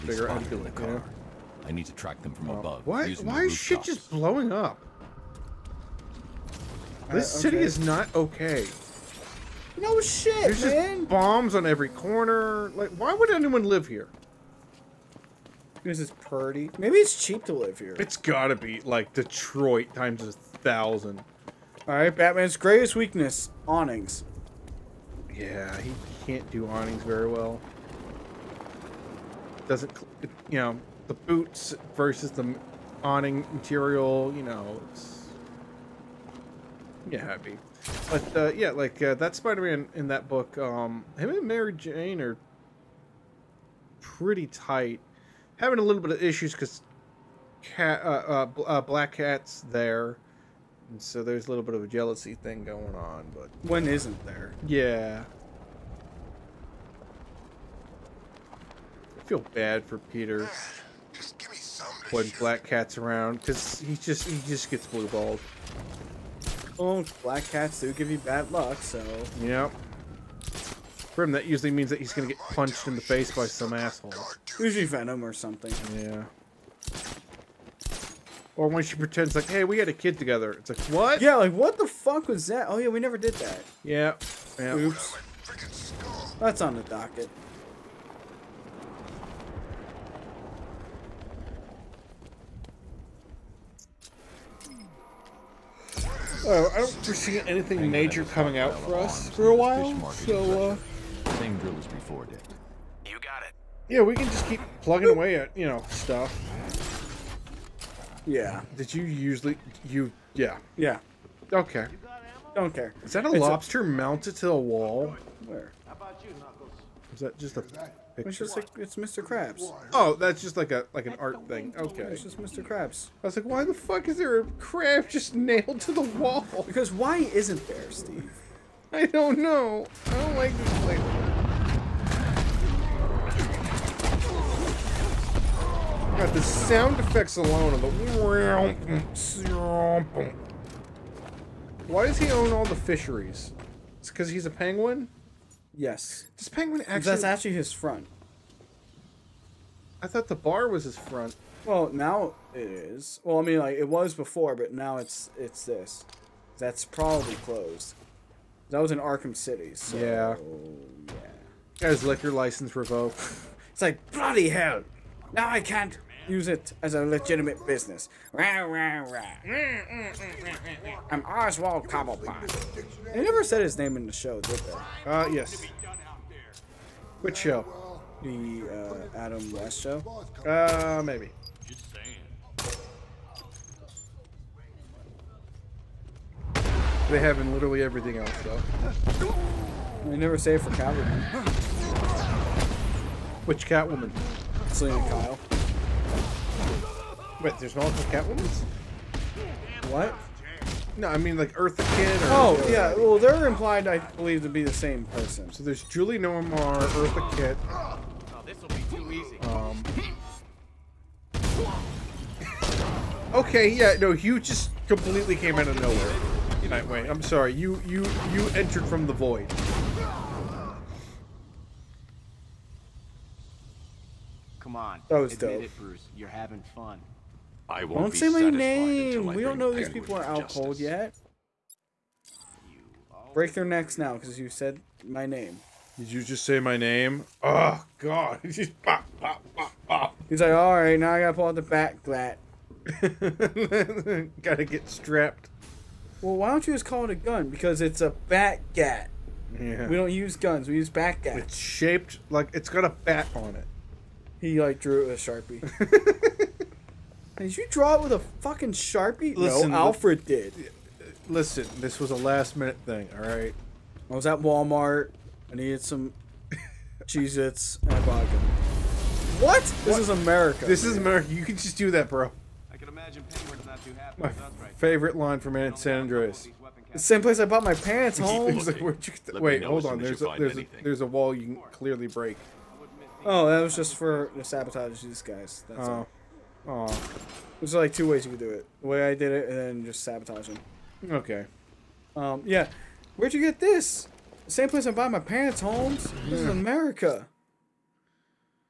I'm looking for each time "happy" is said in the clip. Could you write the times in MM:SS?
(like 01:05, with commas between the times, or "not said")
00:37, 04:33.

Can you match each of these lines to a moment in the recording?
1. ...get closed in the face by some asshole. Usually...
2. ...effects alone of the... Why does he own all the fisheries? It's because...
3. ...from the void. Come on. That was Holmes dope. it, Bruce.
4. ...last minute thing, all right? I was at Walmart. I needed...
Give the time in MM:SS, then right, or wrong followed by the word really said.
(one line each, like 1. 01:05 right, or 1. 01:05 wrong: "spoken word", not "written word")
1. 01:12 wrong: "punched", not "closed"
2. 02:16 right
3. 03:38 wrong: "Admit", not "Holmes"
4. 04:22 right.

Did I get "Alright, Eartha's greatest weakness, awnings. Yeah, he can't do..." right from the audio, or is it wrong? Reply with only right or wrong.
wrong.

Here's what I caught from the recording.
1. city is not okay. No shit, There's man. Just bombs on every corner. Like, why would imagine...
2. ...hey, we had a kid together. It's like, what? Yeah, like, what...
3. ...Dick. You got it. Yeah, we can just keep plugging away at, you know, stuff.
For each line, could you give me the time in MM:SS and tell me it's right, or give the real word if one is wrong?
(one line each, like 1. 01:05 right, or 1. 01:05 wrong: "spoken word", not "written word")
1. 00:07 wrong: "anyone", not "imagine"
2. 01:19 right
3. 01:42 right.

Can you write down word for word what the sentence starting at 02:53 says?
They never said his name in the show, did they?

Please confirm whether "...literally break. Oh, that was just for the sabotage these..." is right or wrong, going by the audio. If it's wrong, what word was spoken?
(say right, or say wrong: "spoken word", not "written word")
wrong: "clearly", not "literally".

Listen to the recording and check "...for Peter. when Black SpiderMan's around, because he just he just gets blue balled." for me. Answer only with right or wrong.
wrong.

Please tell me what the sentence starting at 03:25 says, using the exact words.
So there's Julie Newmar, Eartha Kitt.